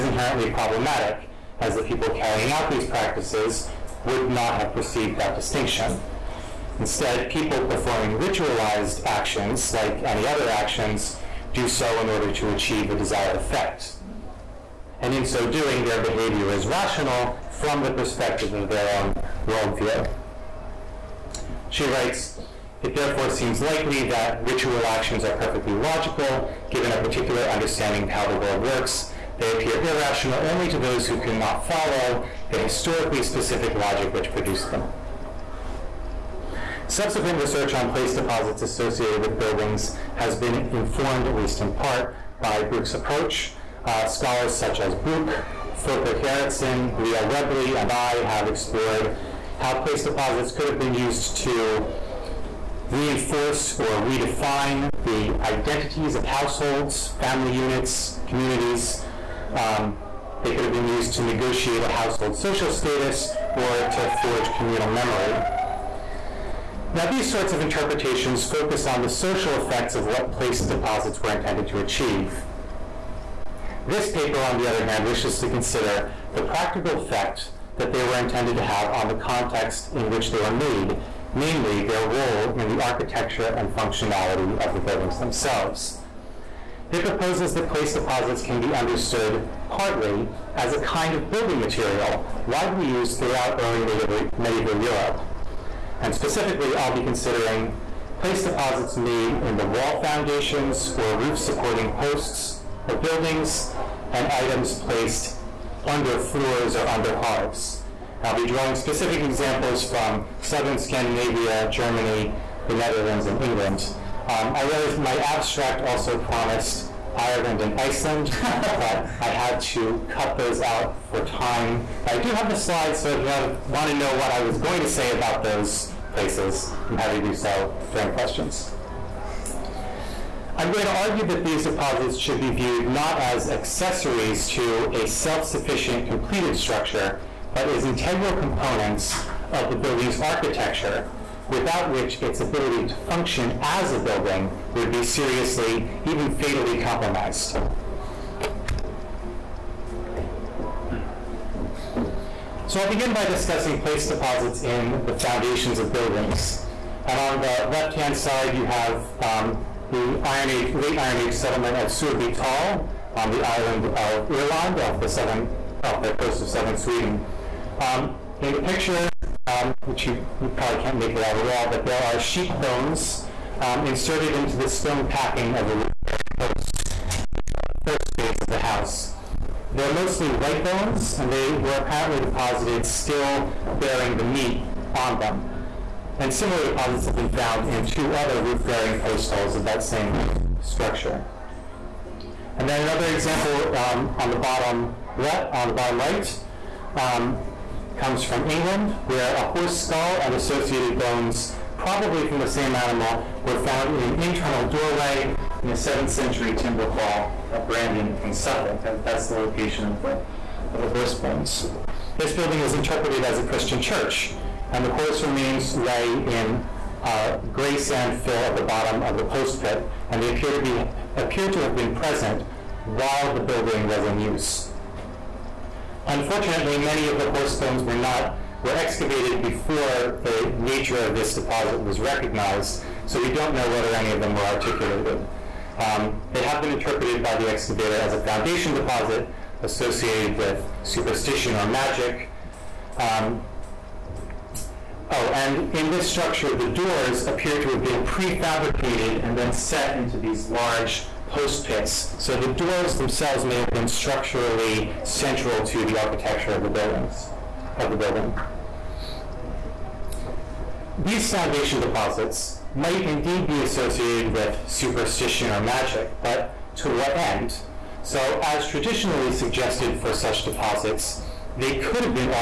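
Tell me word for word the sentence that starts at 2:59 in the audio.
They're mostly leg bones, and they were apparently deposited still bearing the meat on them.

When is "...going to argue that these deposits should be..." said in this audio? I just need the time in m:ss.
2:10.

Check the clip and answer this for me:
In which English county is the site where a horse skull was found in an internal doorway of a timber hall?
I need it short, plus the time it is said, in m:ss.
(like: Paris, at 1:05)
Suffolk, at 3:28.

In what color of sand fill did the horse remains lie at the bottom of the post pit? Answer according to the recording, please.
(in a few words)
Gray.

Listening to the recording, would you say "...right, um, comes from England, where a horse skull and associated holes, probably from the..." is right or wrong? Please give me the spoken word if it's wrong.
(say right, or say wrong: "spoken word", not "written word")
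wrong: "bones", not "holes".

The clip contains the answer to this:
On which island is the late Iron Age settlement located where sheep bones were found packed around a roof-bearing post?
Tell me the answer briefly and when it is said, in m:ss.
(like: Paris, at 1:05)
Öland, at 2:44.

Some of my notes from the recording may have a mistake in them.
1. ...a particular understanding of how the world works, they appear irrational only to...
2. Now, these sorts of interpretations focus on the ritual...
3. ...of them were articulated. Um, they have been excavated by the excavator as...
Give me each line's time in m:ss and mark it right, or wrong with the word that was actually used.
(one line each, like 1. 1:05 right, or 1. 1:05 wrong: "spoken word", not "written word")
1. 0:26 right
2. 1:06 wrong: "social", not "ritual"
3. 3:54 wrong: "interpreted", not "excavated".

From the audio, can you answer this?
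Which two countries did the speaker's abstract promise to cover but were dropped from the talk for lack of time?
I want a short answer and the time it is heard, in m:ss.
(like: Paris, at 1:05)
Ireland and Iceland, at 1:57.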